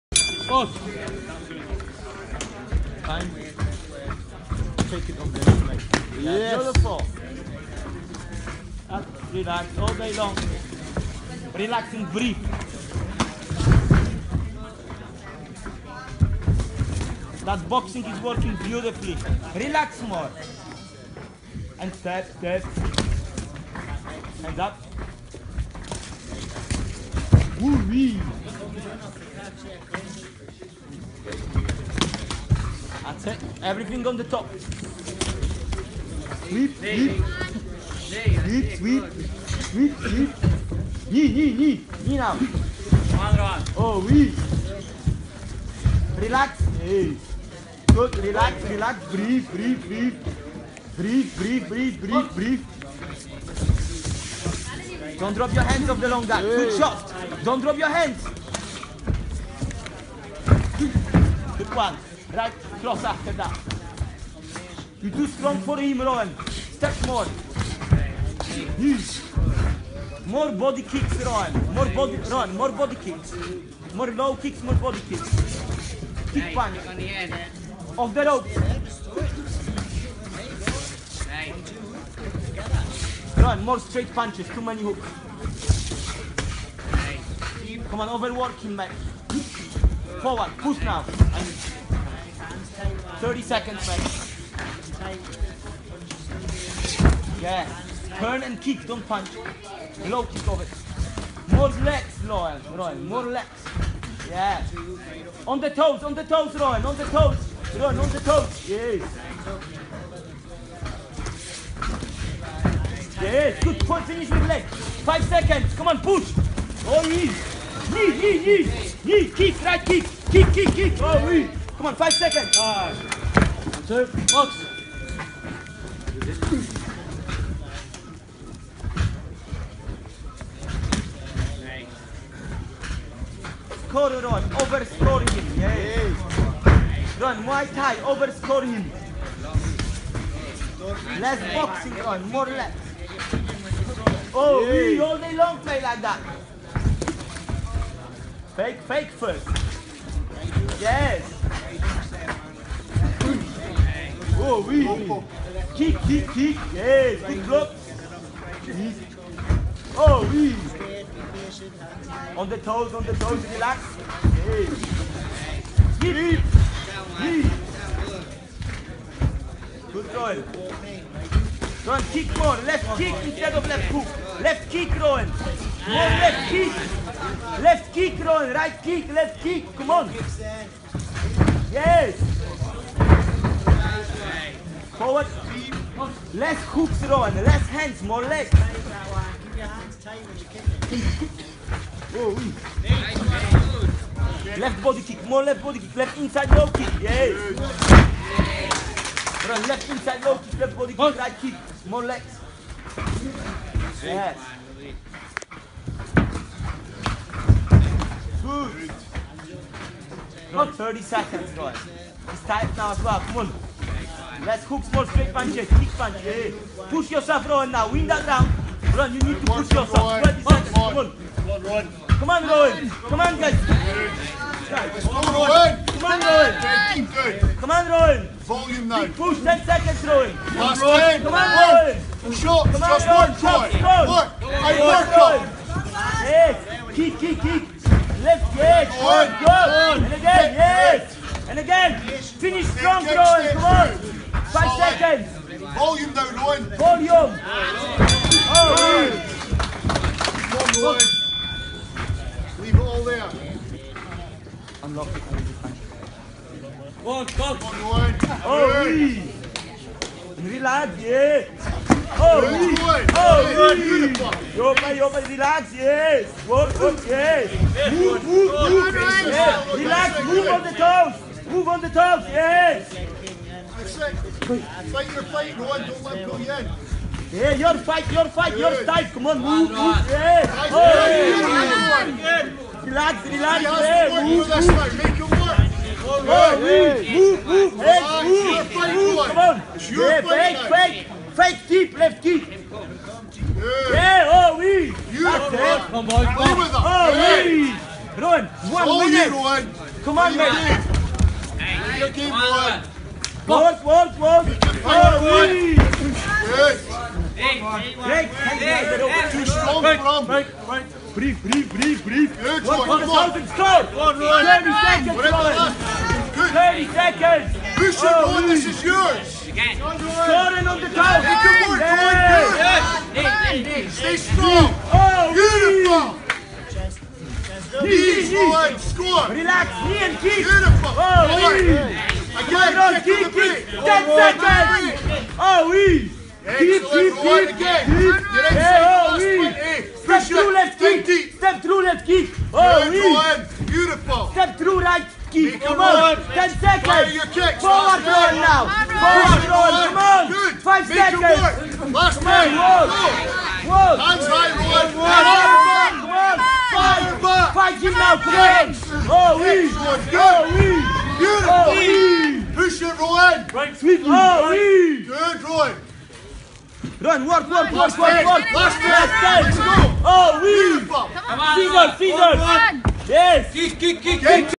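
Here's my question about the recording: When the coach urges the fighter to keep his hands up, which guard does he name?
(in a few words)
long guard.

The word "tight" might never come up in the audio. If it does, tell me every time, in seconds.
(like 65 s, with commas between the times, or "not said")
212 s.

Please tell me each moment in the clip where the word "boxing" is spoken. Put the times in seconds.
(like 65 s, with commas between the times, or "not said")
17 s, 141 s.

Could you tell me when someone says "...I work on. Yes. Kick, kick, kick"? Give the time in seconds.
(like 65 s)
234 s.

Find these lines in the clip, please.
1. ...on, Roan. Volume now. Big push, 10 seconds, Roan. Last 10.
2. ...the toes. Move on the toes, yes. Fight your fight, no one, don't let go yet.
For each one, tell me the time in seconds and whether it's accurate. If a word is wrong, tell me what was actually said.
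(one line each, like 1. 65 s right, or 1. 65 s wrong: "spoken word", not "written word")
1. 227 s right
2. 270 s right.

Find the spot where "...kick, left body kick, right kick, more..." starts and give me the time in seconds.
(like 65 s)
200 s.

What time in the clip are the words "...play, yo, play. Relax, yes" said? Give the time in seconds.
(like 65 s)
264 s.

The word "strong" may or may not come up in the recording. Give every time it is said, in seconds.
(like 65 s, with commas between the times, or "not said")
65 s, 242 s, 309 s, 324 s.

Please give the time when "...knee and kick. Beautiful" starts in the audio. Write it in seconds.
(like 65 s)
329 s.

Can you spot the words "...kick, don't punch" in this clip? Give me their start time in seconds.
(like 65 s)
98 s.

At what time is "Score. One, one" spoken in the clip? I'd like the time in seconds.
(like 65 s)
313 s.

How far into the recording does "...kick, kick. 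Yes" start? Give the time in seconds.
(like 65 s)
156 s.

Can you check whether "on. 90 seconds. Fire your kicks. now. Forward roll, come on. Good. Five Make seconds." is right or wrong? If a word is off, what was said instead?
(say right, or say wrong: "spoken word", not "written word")
wrong: "10", not "90".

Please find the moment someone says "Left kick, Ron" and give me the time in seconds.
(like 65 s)
177 s.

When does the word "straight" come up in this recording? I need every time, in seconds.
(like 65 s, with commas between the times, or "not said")
83 s, 215 s.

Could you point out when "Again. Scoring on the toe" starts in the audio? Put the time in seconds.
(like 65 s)
319 s.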